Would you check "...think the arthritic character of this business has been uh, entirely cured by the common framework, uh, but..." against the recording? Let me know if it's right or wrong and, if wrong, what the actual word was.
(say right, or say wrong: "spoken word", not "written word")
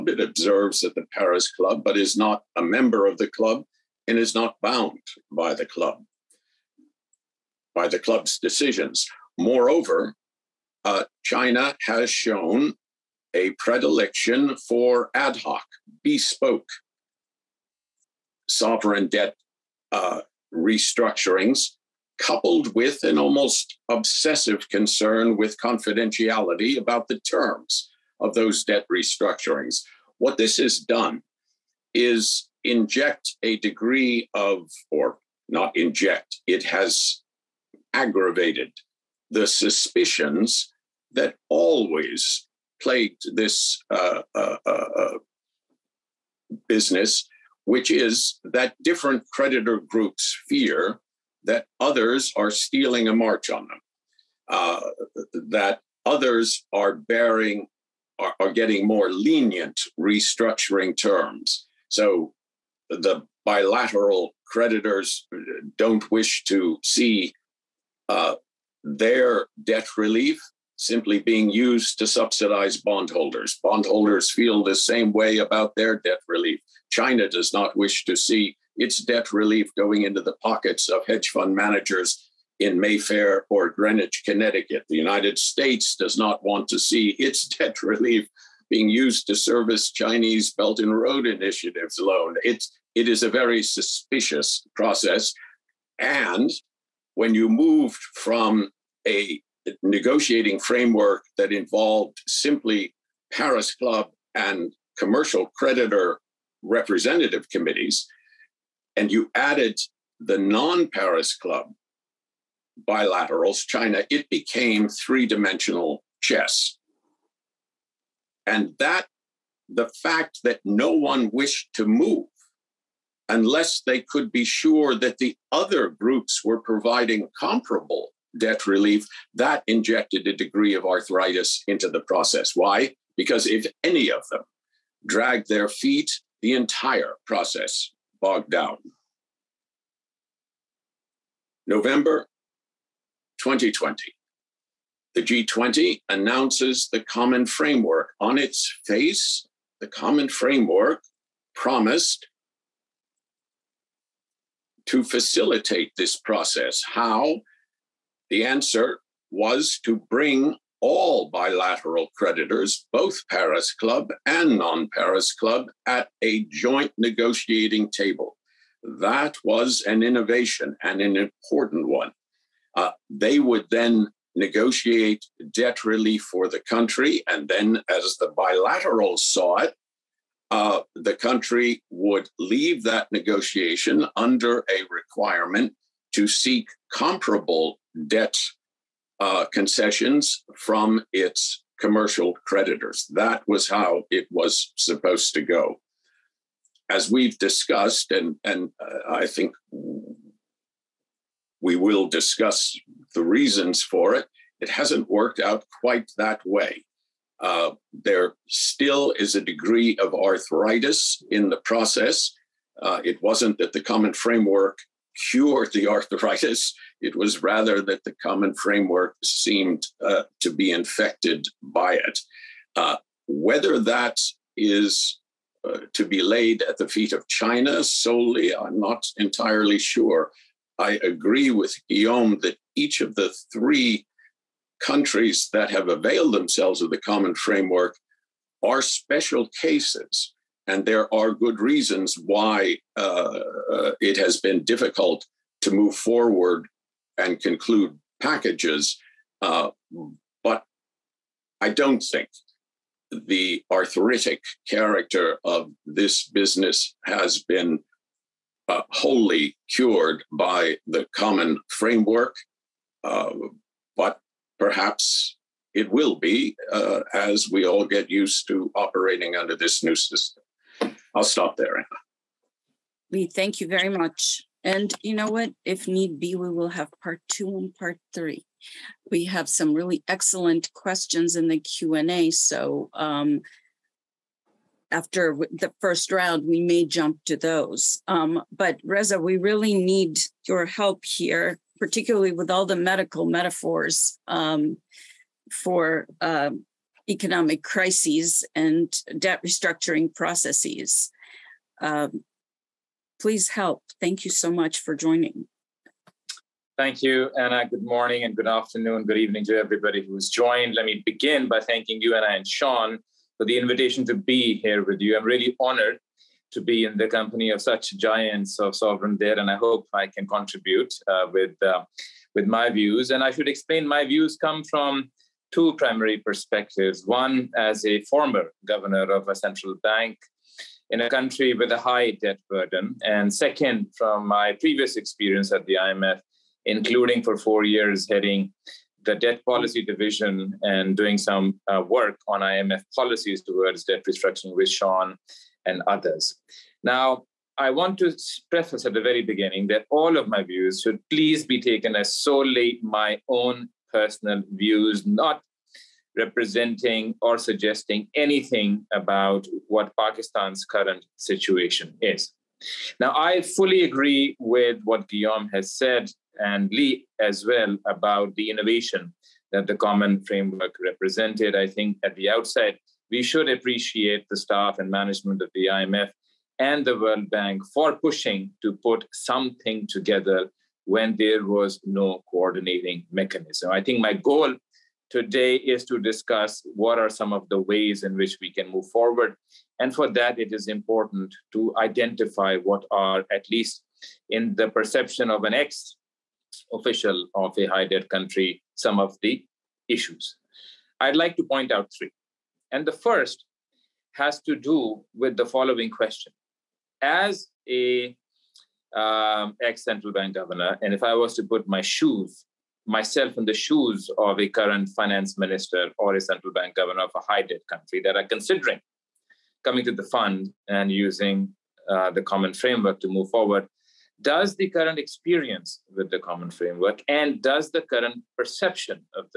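wrong: "wholly", not "entirely".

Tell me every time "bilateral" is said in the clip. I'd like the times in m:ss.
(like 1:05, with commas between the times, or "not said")
1:03, 1:52, 2:41, 2:58.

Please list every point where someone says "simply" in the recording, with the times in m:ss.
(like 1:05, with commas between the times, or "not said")
1:10, 1:42.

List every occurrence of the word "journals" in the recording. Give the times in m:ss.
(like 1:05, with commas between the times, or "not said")
not said.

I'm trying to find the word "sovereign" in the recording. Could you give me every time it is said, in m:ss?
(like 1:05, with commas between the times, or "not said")
0:18, 5:18.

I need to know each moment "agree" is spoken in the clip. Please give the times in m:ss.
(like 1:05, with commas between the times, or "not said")
3:51, 6:03.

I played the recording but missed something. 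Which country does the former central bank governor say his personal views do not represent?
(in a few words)
Pakistan.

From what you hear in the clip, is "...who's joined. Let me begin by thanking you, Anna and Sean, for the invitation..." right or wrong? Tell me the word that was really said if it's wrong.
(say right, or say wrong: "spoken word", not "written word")
right.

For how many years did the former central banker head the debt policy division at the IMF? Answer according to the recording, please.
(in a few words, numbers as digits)
4.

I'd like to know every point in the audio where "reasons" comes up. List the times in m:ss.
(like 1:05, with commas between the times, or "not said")
3:23, 4:01.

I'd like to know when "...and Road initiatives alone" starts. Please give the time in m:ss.
1:30.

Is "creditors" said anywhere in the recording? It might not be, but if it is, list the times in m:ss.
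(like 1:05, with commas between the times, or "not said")
0:49, 1:04, 1:45, 2:42, 3:12.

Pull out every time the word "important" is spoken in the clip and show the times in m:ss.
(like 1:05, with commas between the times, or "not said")
2:51, 6:30.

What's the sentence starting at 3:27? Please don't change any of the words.
Uh, there still is a degree of arthritis in the process.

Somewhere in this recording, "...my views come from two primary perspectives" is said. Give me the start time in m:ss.
5:23.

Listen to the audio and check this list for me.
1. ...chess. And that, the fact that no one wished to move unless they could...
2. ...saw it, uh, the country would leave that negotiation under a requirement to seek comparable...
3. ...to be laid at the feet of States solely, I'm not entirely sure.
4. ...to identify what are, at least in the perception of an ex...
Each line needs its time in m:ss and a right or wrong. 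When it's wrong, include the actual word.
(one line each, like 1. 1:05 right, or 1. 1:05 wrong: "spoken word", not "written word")
1. 1:56 right
2. 2:59 right
3. 3:45 wrong: "China", not "States"
4. 6:31 right.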